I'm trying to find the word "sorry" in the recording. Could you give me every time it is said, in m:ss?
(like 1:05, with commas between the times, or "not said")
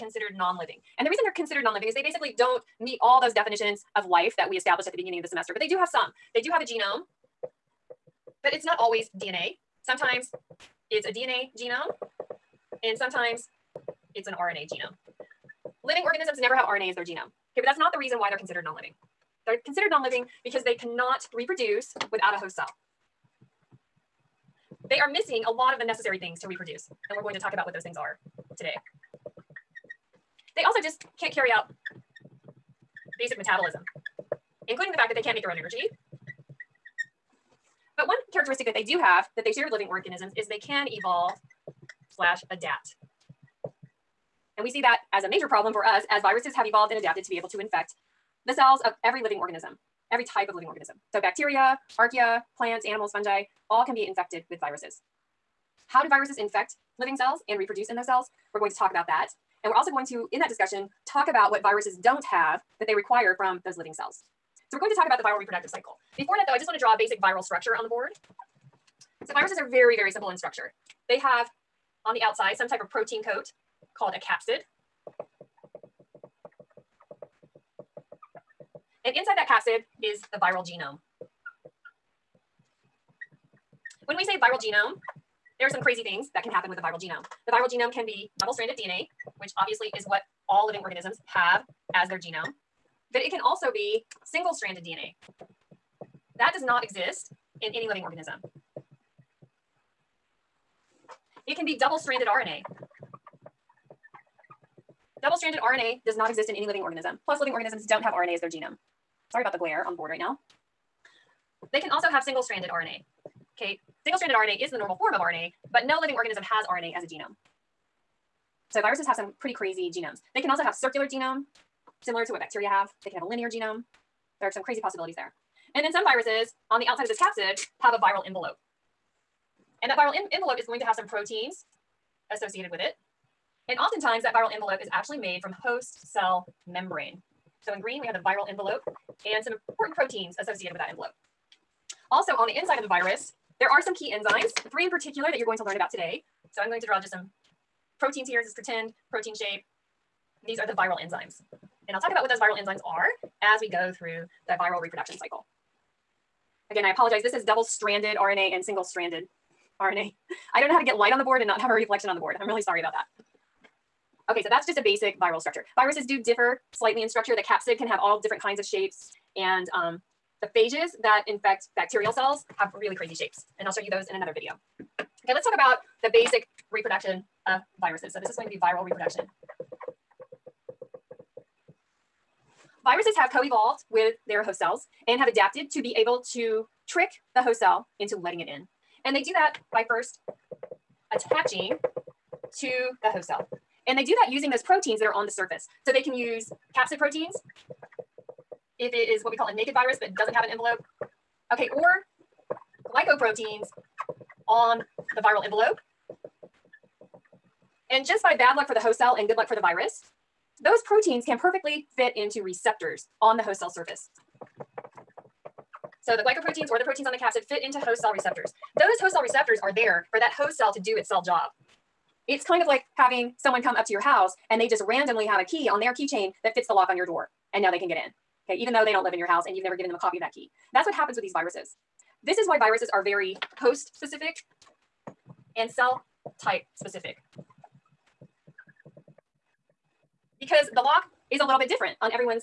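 1:49, 2:42.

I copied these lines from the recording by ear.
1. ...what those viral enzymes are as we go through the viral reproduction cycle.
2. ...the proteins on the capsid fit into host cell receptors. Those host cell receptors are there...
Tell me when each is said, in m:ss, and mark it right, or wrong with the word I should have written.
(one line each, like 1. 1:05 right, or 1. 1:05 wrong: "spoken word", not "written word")
1. 2:32 right
2. 3:36 right.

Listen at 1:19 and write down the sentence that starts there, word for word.
And inside that capsid is the viral genome.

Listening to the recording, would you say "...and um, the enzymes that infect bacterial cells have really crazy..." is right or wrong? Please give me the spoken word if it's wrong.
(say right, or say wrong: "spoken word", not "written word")
wrong: "phages", not "enzymes".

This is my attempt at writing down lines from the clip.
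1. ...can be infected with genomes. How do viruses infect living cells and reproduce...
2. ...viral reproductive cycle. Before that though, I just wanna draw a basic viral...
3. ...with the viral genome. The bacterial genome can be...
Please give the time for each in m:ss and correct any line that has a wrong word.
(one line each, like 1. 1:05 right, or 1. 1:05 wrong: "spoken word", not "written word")
1. 0:53 wrong: "viruses", not "genomes"
2. 1:05 right
3. 1:26 wrong: "viral", not "bacterial".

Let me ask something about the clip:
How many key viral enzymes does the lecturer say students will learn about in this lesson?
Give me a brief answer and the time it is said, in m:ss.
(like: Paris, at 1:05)
3, at 2:24.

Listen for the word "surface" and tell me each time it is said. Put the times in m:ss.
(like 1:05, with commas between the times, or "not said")
3:15, 3:33.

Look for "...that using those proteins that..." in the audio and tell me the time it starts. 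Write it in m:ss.
3:14.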